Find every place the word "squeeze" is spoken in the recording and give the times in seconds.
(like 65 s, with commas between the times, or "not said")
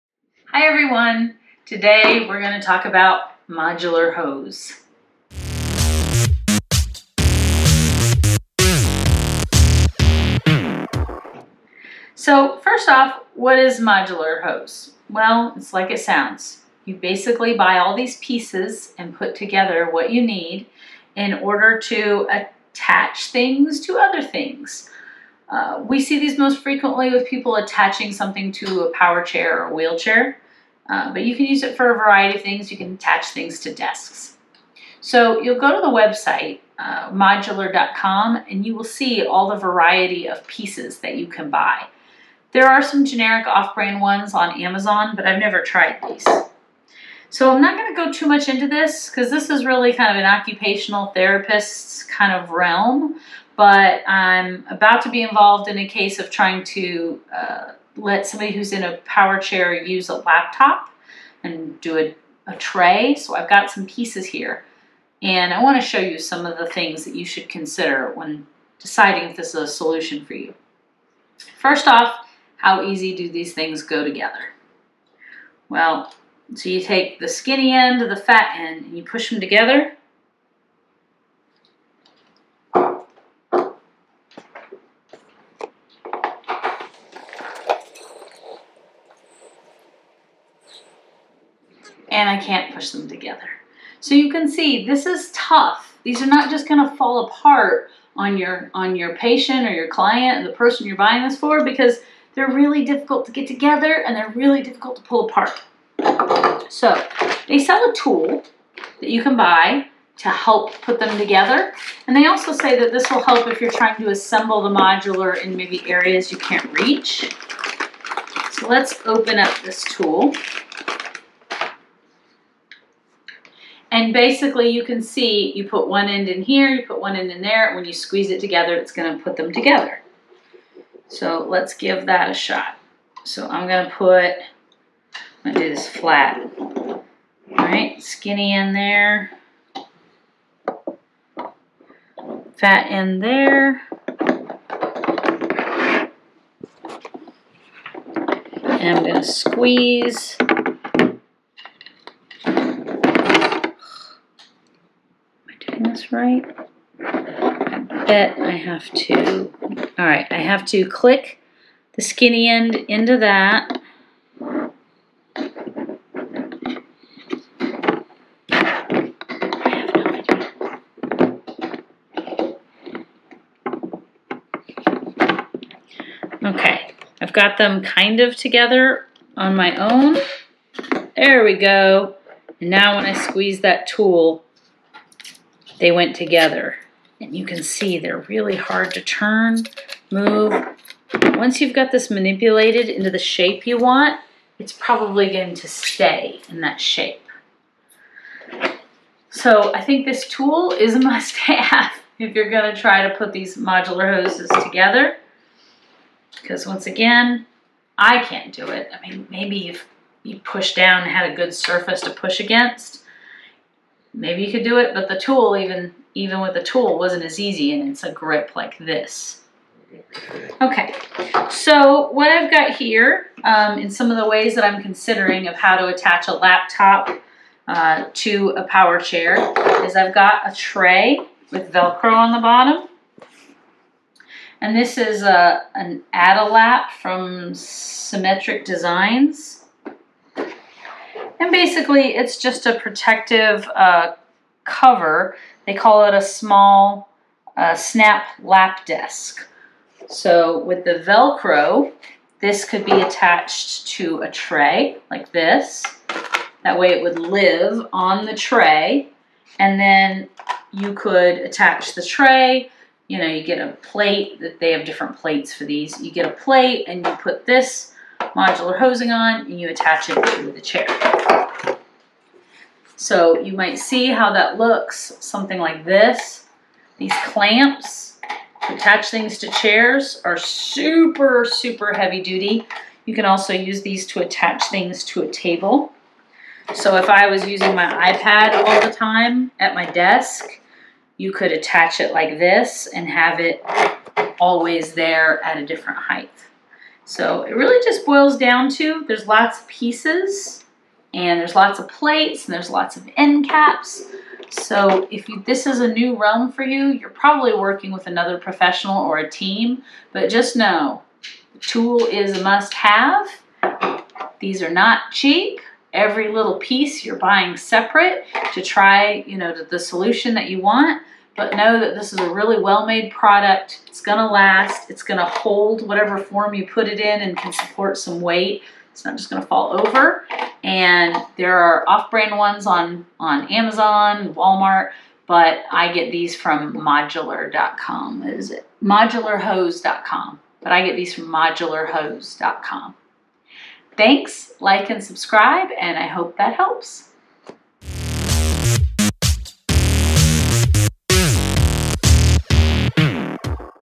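127 s, 149 s, 183 s.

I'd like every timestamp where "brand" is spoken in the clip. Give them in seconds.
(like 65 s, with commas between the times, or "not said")
43 s, 331 s.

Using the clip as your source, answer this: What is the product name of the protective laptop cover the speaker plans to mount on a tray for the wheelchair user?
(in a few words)
Adalap.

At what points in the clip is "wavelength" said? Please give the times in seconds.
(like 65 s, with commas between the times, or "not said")
not said.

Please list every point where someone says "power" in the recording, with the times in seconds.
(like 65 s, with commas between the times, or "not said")
28 s, 59 s, 228 s.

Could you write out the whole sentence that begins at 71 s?
First off, how easy do these things go together?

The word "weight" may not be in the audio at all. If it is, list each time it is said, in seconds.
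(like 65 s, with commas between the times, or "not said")
328 s.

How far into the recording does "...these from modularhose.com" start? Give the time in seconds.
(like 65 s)
340 s.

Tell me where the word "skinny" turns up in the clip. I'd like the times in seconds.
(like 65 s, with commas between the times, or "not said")
77 s, 138 s, 162 s.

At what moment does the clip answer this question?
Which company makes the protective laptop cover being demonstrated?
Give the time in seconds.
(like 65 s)
237 s.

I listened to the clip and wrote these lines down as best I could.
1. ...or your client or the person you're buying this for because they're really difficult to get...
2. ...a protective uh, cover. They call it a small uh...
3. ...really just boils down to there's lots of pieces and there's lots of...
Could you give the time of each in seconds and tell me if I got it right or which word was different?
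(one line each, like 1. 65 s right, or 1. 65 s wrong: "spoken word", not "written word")
1. 99 s right
2. 242 s right
3. 297 s right.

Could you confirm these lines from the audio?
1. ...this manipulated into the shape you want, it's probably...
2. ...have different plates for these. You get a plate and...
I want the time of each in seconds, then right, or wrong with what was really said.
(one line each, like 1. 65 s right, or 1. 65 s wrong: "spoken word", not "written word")
1. 191 s right
2. 264 s right.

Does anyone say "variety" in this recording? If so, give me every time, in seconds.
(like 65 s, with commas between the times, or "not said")
31 s, 39 s.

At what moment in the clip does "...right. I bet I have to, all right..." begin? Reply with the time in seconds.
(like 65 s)
156 s.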